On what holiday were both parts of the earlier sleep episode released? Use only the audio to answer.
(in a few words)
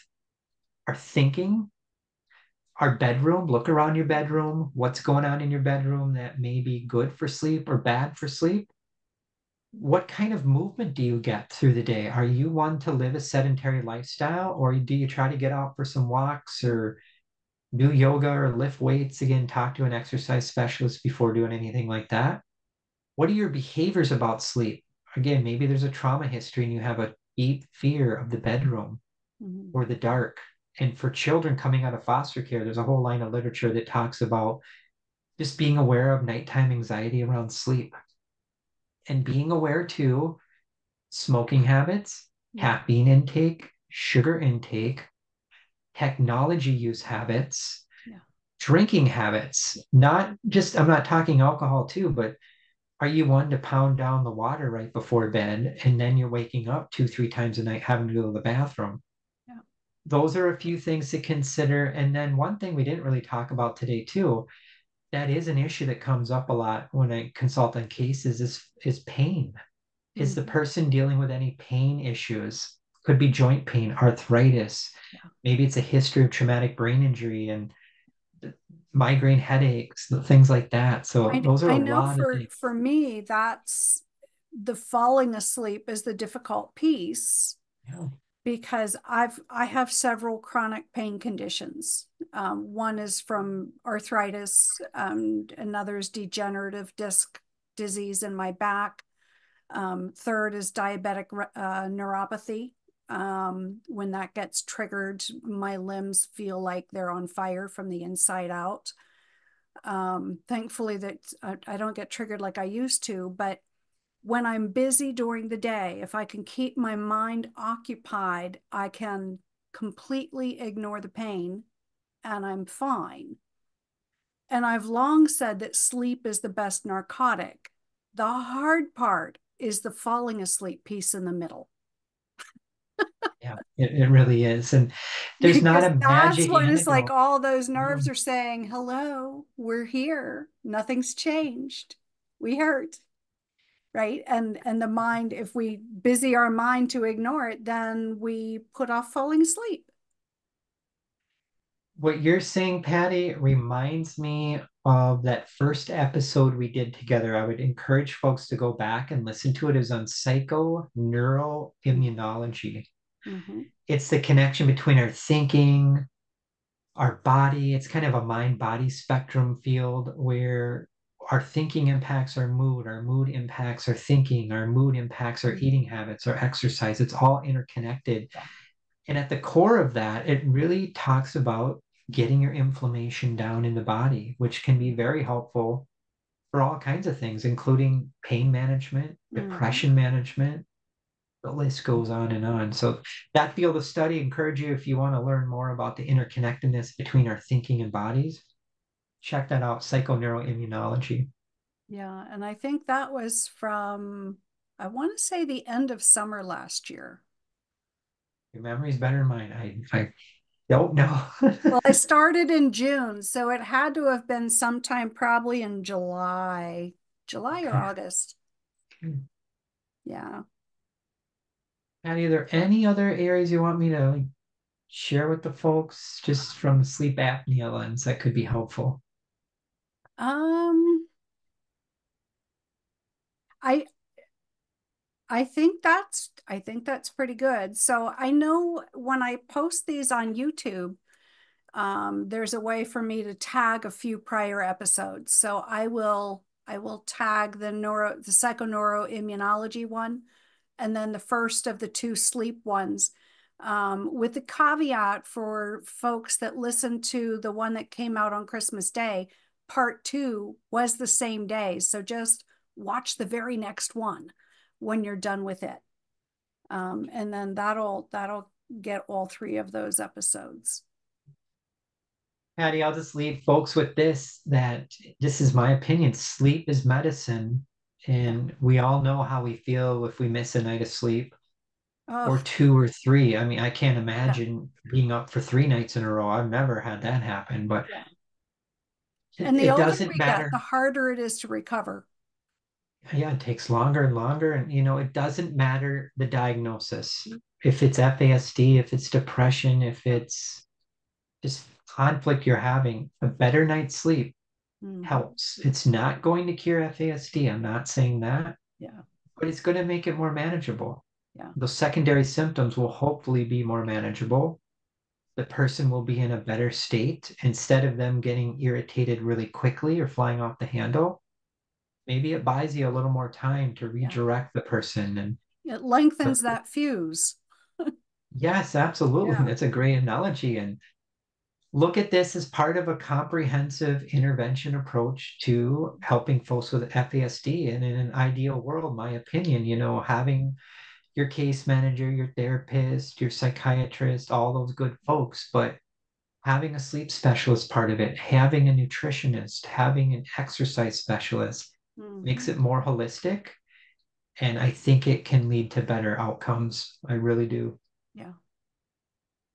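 Christmas Day.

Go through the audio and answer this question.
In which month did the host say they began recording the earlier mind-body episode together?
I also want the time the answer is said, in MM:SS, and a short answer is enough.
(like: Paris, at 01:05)
June, at 03:32.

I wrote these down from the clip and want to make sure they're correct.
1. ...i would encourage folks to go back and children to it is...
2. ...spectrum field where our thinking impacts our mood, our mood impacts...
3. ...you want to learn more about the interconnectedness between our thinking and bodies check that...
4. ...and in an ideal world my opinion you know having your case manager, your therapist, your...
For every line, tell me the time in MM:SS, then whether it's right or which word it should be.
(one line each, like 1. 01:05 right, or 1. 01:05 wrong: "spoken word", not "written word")
1. 02:37 wrong: "listen", not "children"
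2. 02:48 right
3. 03:14 right
4. 05:37 right.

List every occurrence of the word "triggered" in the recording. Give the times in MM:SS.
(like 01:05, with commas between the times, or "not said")
01:44, 01:52.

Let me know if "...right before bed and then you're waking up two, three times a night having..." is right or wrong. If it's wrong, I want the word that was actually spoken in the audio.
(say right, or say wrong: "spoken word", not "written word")
right.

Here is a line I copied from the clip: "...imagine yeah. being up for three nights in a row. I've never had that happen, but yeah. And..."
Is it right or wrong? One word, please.
right.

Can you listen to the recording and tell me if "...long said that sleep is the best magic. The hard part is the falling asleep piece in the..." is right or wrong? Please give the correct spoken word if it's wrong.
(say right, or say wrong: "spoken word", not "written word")
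wrong: "narcotic", not "magic".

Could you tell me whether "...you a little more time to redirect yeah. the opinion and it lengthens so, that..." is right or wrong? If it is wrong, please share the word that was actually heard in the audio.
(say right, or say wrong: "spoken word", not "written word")
wrong: "person", not "opinion".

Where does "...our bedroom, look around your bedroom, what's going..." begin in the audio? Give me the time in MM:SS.
00:02.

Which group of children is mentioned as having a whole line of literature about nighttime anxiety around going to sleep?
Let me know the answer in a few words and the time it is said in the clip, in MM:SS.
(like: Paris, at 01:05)
Children coming out of foster care, at 00:32.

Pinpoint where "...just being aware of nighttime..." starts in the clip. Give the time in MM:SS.
00:35.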